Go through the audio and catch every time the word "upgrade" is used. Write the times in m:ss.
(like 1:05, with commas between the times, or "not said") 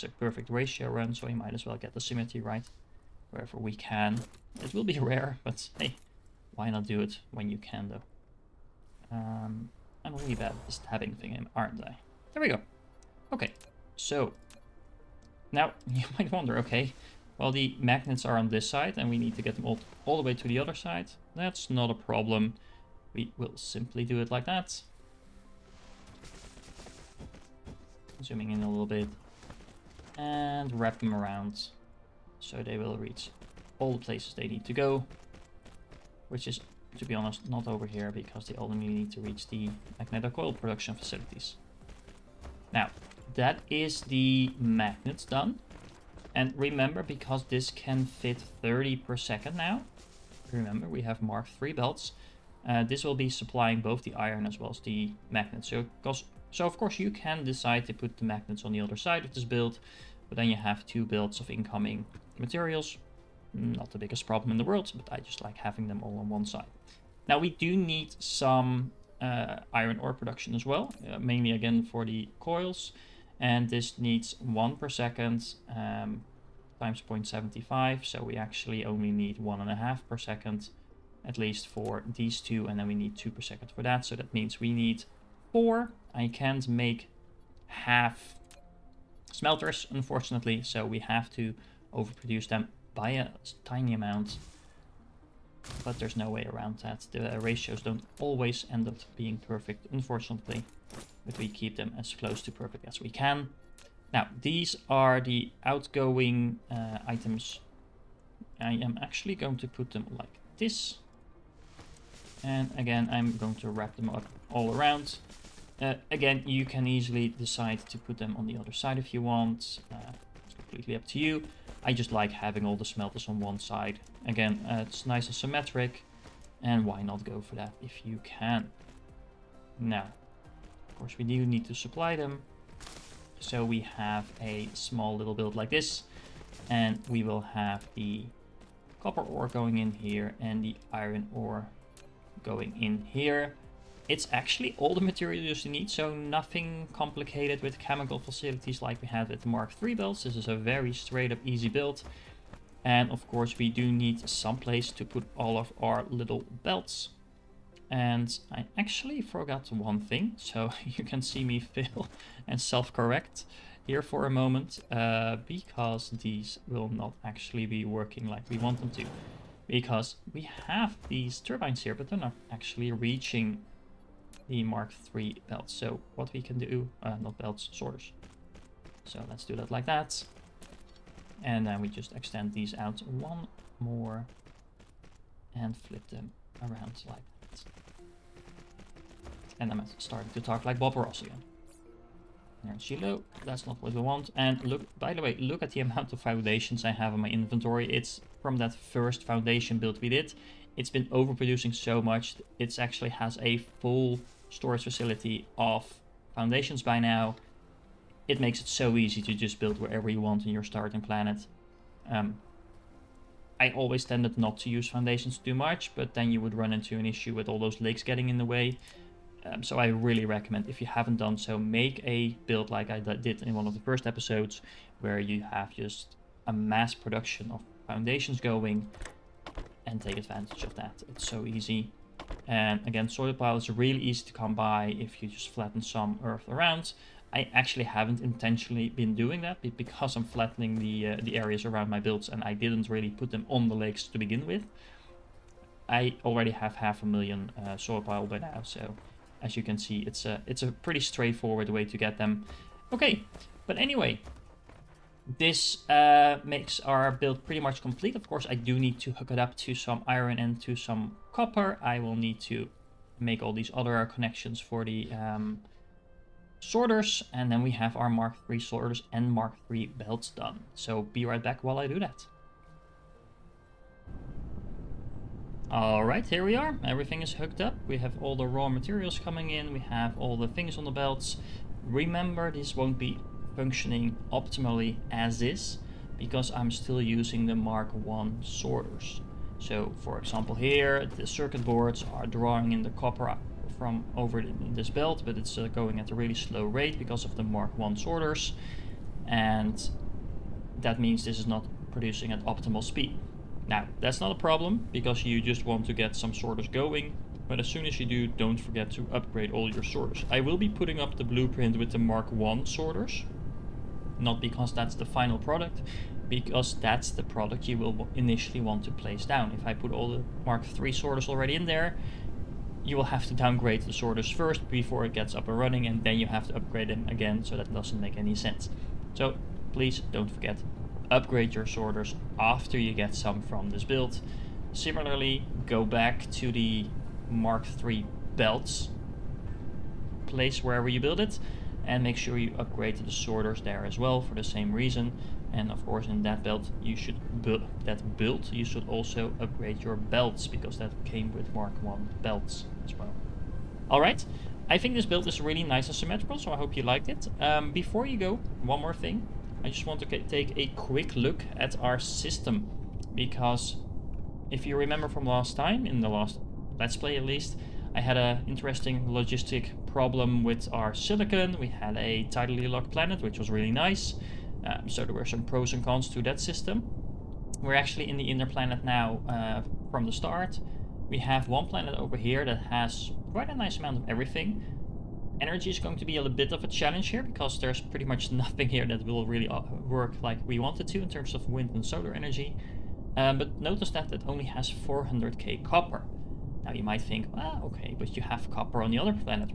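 5:09, 5:26, 5:31, 5:42, 5:49.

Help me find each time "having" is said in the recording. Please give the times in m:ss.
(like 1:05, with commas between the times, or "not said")
1:05, 2:02.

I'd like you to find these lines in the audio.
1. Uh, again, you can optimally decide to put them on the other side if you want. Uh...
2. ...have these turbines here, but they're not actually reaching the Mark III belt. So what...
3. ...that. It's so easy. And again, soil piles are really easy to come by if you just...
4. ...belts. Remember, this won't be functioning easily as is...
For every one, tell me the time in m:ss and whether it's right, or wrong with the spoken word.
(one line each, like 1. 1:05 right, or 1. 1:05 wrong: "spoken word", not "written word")
1. 1:55 wrong: "easily", not "optimally"
2. 2:50 right
3. 3:50 right
4. 4:40 wrong: "optimally", not "easily".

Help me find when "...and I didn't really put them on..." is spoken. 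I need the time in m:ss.
4:02.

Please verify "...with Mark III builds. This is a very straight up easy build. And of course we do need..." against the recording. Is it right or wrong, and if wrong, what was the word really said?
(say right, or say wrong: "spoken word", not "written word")
right.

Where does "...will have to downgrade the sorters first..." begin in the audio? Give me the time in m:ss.
5:22.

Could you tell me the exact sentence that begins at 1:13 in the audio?
And this needs one per second um, times 0.75.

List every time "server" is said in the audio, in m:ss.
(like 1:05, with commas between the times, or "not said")
not said.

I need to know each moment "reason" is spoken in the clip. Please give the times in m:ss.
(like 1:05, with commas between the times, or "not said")
5:44.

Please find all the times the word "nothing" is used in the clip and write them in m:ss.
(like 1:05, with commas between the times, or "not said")
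2:26, 6:28.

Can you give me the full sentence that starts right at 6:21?
We have one planet over here that has quite a nice amount of everything.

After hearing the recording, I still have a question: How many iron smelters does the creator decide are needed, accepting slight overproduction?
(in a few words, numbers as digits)
4.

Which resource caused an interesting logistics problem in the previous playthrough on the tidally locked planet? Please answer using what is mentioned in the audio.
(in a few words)
silicon.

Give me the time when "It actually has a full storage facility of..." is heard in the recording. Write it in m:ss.
3:22.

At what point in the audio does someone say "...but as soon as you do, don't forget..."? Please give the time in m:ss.
5:07.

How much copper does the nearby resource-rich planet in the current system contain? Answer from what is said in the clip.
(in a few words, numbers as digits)
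400k.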